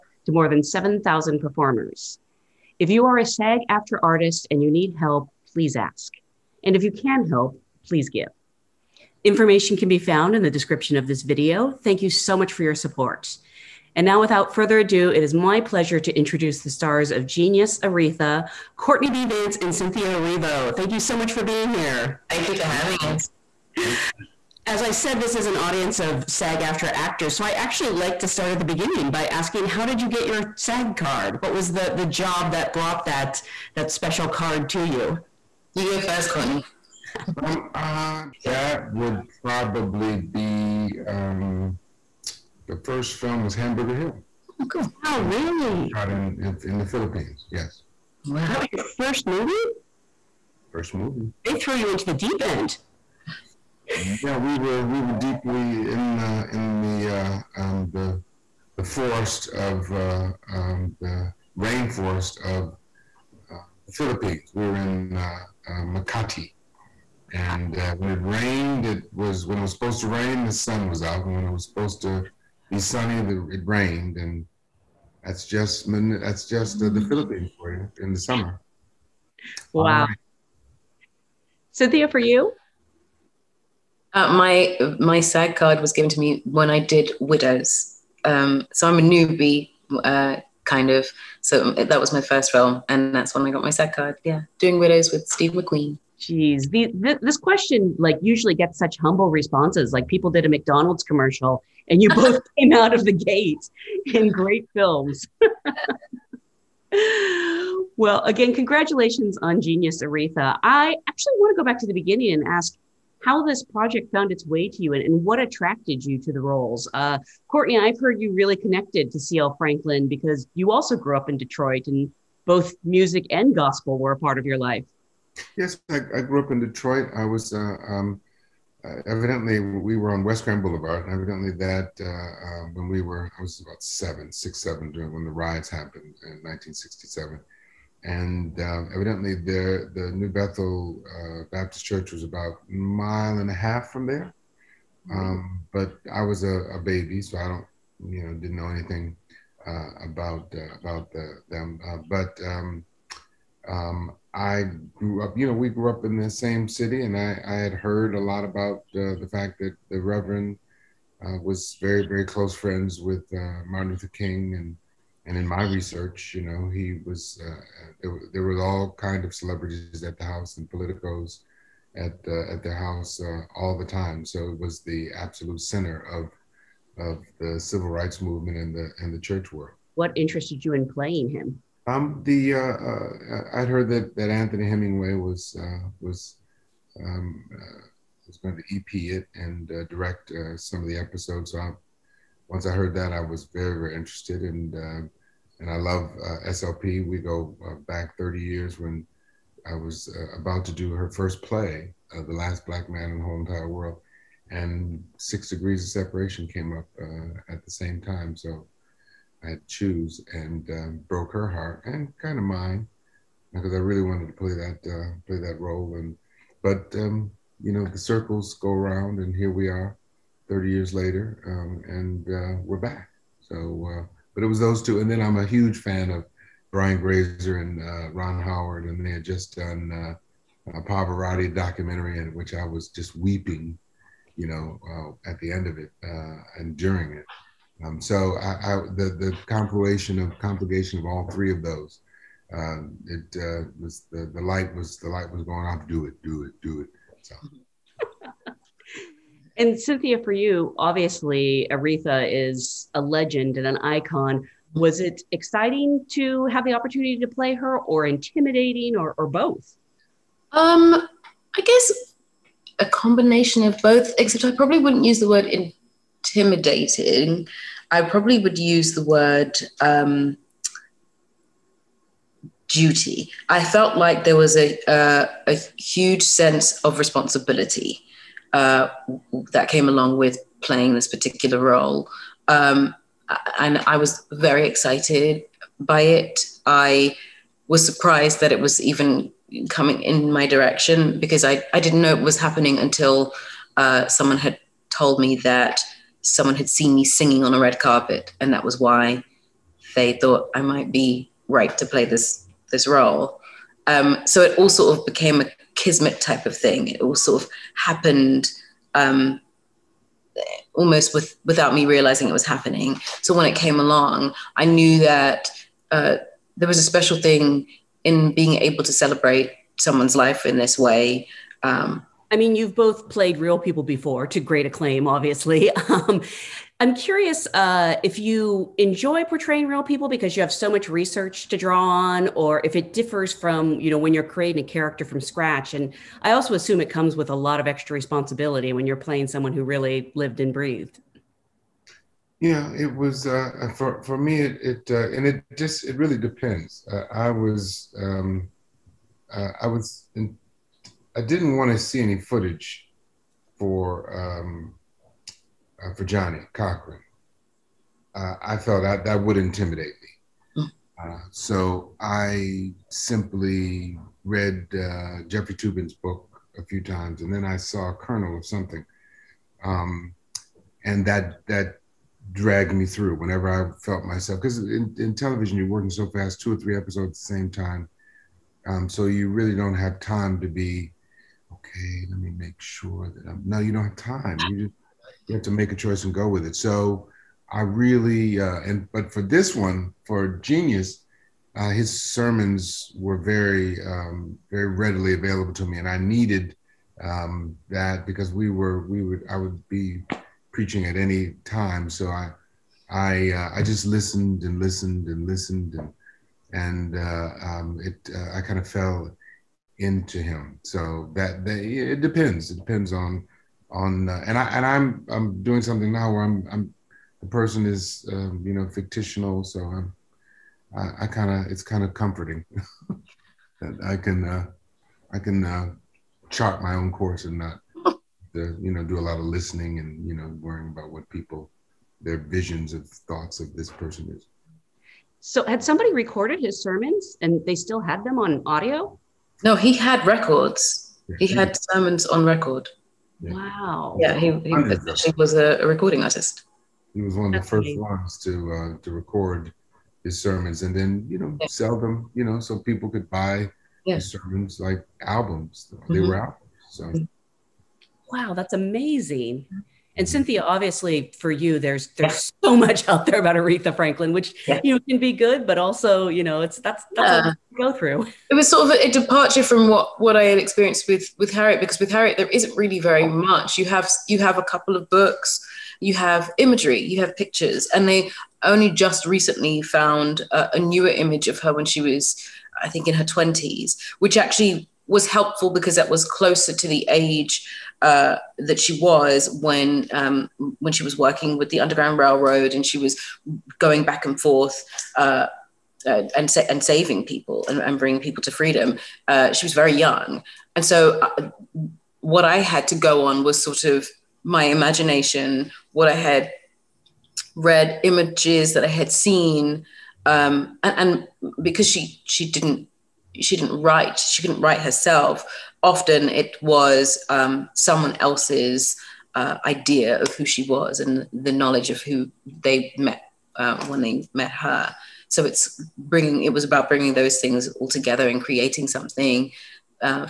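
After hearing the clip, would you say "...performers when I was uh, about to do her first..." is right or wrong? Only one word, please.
wrong.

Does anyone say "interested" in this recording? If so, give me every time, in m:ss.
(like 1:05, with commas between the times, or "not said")
3:00, 3:13.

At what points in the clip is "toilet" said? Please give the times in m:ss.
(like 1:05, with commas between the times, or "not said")
not said.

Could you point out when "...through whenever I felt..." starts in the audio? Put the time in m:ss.
6:12.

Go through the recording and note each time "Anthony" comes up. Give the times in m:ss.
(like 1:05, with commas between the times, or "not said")
3:04.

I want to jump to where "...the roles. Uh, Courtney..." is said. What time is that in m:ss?
1:56.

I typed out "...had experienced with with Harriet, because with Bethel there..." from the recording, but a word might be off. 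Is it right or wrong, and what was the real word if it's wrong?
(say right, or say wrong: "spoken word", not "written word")
wrong: "Harriet", not "Bethel".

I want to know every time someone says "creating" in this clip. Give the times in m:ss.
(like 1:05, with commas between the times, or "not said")
5:34, 8:48.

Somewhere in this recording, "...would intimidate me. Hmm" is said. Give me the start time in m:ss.
5:59.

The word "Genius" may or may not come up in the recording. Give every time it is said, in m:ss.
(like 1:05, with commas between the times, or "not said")
0:17, 1:49, 6:30.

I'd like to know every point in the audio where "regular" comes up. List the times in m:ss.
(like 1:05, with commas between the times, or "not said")
not said.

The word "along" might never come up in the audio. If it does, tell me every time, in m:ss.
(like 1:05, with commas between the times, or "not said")
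4:39, 5:13.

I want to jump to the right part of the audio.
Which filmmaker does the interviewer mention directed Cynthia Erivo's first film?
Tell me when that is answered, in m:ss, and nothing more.
1:35.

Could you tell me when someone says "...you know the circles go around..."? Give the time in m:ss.
3:37.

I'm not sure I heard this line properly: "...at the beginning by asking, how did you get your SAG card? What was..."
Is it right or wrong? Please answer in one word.
right.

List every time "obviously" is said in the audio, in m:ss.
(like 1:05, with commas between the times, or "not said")
4:10, 5:25, 7:40.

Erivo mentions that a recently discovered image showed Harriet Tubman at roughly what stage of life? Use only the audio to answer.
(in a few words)
her twenties.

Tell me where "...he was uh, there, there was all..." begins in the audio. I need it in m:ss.
2:46.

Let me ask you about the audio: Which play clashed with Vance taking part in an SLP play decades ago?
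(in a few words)
Six Degrees of Separation.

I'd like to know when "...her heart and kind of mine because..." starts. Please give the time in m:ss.
3:31.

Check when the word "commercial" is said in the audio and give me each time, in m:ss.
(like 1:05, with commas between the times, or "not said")
1:41.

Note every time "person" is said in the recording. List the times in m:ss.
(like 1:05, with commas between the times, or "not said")
6:57, 7:13.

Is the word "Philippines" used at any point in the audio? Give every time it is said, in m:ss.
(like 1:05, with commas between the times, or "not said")
0:46, 1:03, 1:17.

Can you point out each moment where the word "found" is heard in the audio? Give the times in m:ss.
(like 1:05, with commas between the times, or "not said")
0:09, 1:54, 7:59.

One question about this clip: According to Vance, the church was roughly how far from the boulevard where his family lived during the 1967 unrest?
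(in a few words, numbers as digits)
a mile and a half.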